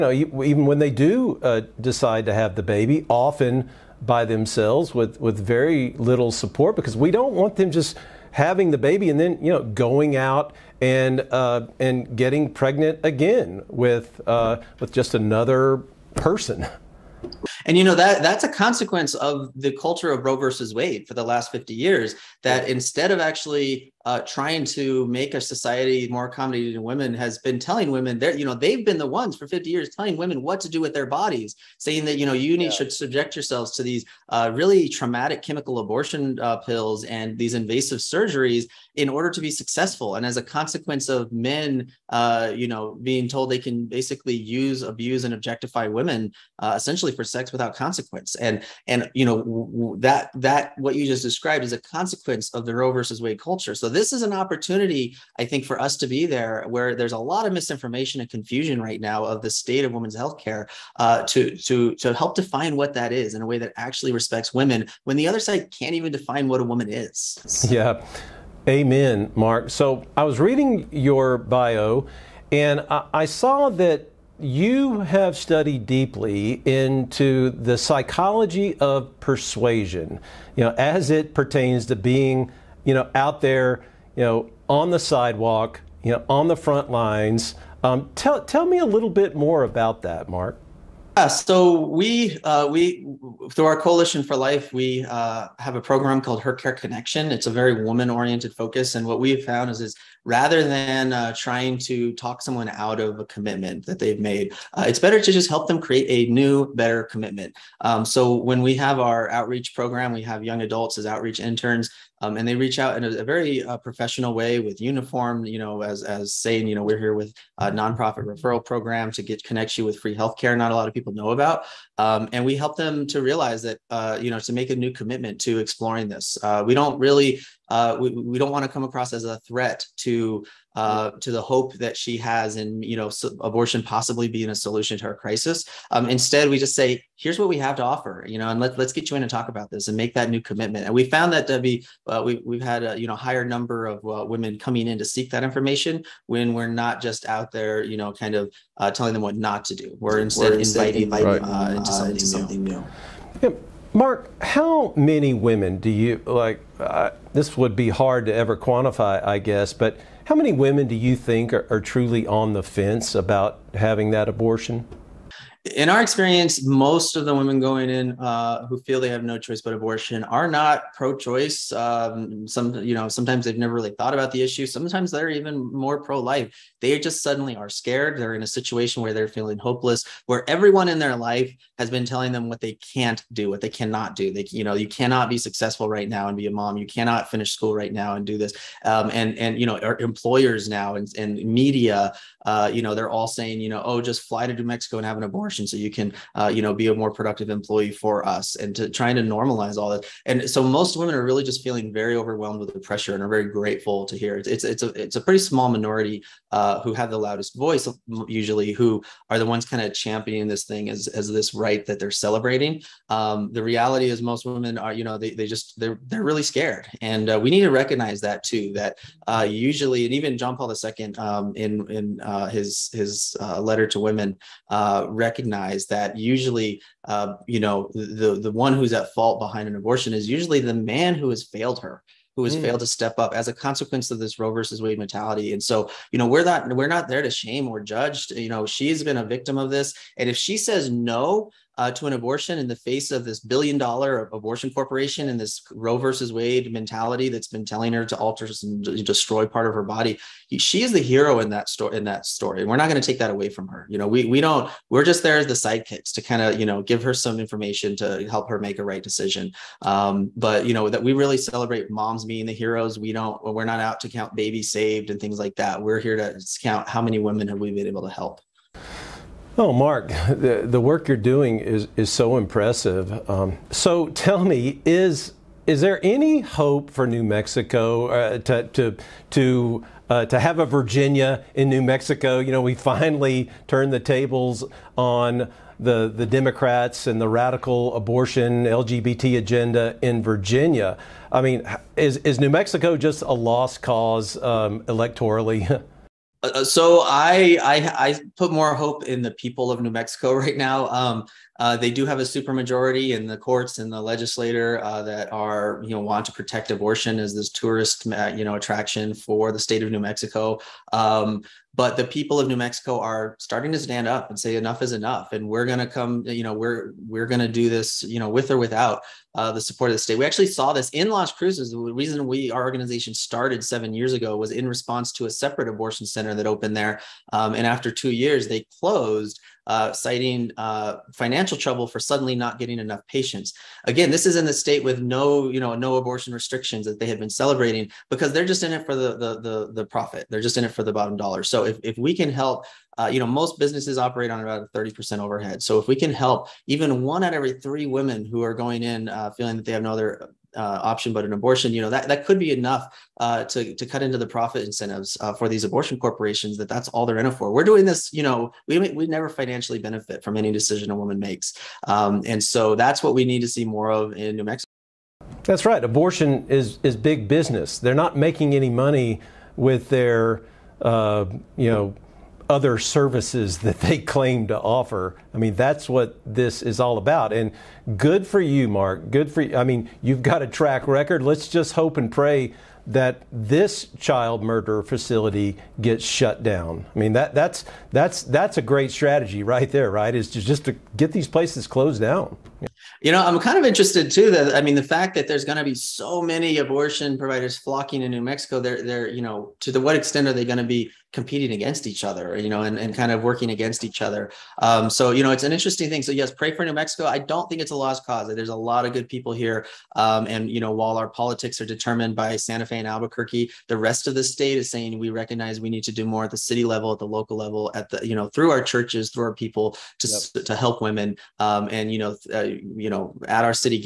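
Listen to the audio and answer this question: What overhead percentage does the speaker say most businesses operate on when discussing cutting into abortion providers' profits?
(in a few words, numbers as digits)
30%.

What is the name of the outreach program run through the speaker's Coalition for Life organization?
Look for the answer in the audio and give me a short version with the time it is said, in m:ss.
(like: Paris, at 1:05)
Her Care Connection, at 1:36.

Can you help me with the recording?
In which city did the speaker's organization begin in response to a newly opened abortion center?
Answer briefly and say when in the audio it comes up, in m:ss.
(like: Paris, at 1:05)
Las Cruces, at 5:21.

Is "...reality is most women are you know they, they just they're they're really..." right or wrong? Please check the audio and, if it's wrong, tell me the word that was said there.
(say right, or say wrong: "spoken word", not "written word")
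right.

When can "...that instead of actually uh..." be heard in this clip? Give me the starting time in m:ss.
0:22.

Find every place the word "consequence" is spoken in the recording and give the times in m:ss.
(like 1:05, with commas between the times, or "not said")
0:18, 0:40, 0:47, 0:51, 3:53.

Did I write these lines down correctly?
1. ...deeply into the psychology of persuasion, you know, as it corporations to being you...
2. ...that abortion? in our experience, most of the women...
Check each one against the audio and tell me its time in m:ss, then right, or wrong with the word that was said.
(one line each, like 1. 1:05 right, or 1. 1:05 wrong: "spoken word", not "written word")
1. 1:15 wrong: "pertains", not "corporations"
2. 2:44 right.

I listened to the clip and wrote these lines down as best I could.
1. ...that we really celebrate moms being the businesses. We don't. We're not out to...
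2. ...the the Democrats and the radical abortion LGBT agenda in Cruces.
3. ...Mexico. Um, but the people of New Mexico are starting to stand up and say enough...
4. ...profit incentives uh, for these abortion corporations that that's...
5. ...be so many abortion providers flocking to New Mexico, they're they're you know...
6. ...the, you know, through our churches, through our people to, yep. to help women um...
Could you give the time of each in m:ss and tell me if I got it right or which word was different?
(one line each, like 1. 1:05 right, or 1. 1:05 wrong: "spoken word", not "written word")
1. 4:20 wrong: "heroes", not "businesses"
2. 4:45 wrong: "Virginia", not "Cruces"
3. 5:10 right
4. 5:54 right
5. 6:35 right
6. 6:57 right.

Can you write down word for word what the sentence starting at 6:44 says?
Um, so, you know, it's an interesting thing.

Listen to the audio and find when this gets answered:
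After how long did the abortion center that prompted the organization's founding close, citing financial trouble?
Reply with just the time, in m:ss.
5:27.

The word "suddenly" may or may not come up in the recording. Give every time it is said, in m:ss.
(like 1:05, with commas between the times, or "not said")
2:57, 5:31.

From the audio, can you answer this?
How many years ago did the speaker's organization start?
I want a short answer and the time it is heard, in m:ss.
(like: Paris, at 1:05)
7, at 5:23.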